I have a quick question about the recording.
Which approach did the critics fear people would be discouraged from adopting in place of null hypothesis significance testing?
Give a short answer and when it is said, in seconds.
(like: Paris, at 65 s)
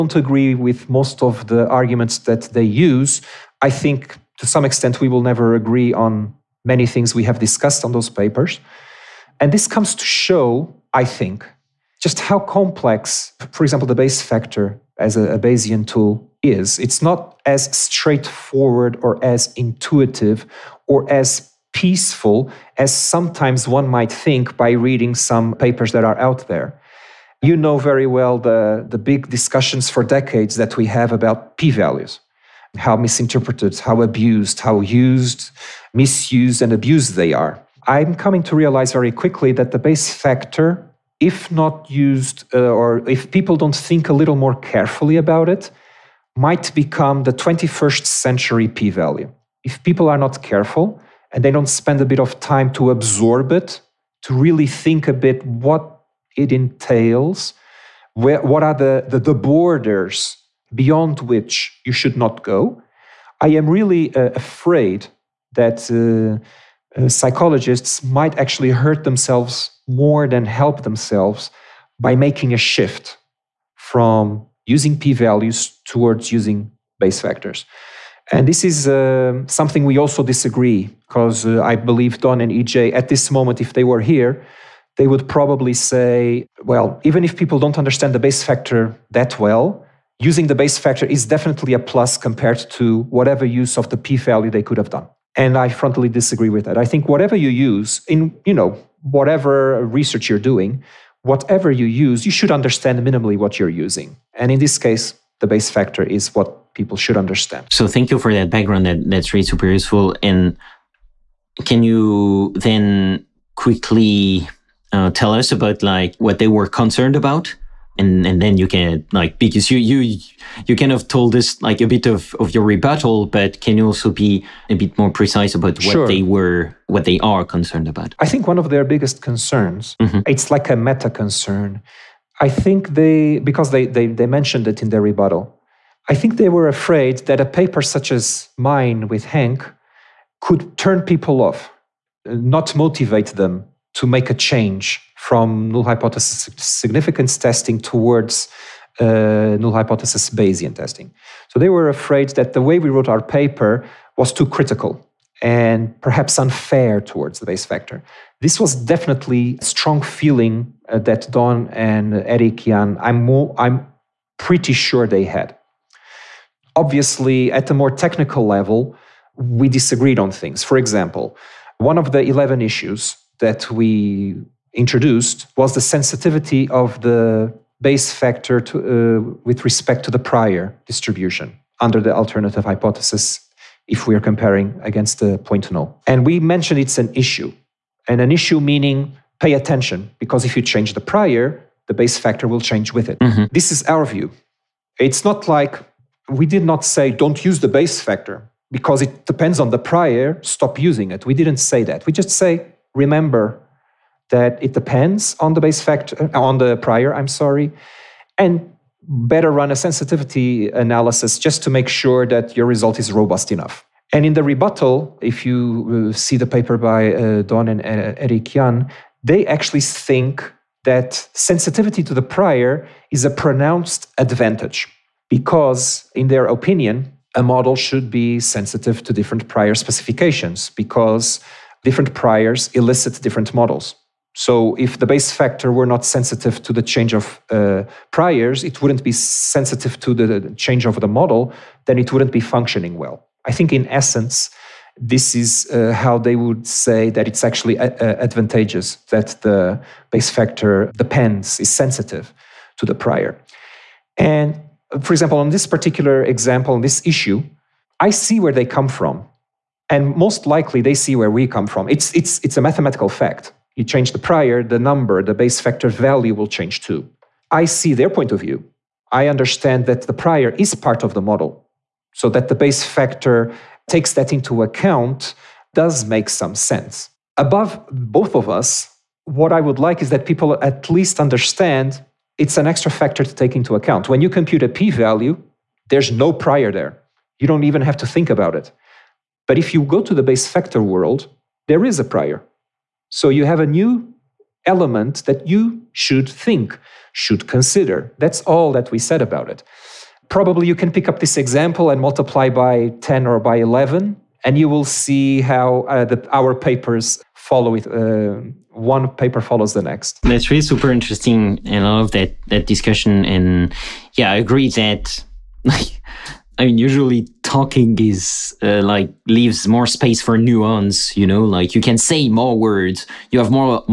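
null hypothesis Bayesian testing, at 149 s.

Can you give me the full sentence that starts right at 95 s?
And I frontally disagree with that.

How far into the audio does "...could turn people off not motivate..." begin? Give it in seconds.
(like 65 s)
140 s.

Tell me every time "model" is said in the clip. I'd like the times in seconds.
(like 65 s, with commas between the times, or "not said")
227 s, 233 s, 241 s, 271 s.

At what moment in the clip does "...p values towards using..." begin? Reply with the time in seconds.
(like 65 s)
74 s.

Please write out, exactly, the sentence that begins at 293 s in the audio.
So you have a new element that you should think, should consider.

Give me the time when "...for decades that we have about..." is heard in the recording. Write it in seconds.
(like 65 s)
29 s.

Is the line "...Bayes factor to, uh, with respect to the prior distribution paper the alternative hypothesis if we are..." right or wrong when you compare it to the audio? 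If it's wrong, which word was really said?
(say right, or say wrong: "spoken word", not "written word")
wrong: "under", not "paper".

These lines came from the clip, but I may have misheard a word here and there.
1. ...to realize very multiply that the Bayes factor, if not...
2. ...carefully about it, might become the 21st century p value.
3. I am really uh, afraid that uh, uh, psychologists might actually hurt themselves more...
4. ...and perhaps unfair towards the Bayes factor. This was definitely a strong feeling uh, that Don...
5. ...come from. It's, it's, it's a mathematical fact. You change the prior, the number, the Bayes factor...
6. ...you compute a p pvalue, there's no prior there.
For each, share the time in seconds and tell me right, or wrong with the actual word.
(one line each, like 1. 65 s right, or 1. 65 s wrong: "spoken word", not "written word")
1. 38 s wrong: "quickly", not "multiply"
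2. 44 s right
3. 63 s right
4. 155 s right
5. 261 s right
6. 284 s wrong: "value", not "pvalue".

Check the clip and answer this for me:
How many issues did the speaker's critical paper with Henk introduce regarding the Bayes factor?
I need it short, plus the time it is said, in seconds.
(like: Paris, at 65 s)
11, at 172 s.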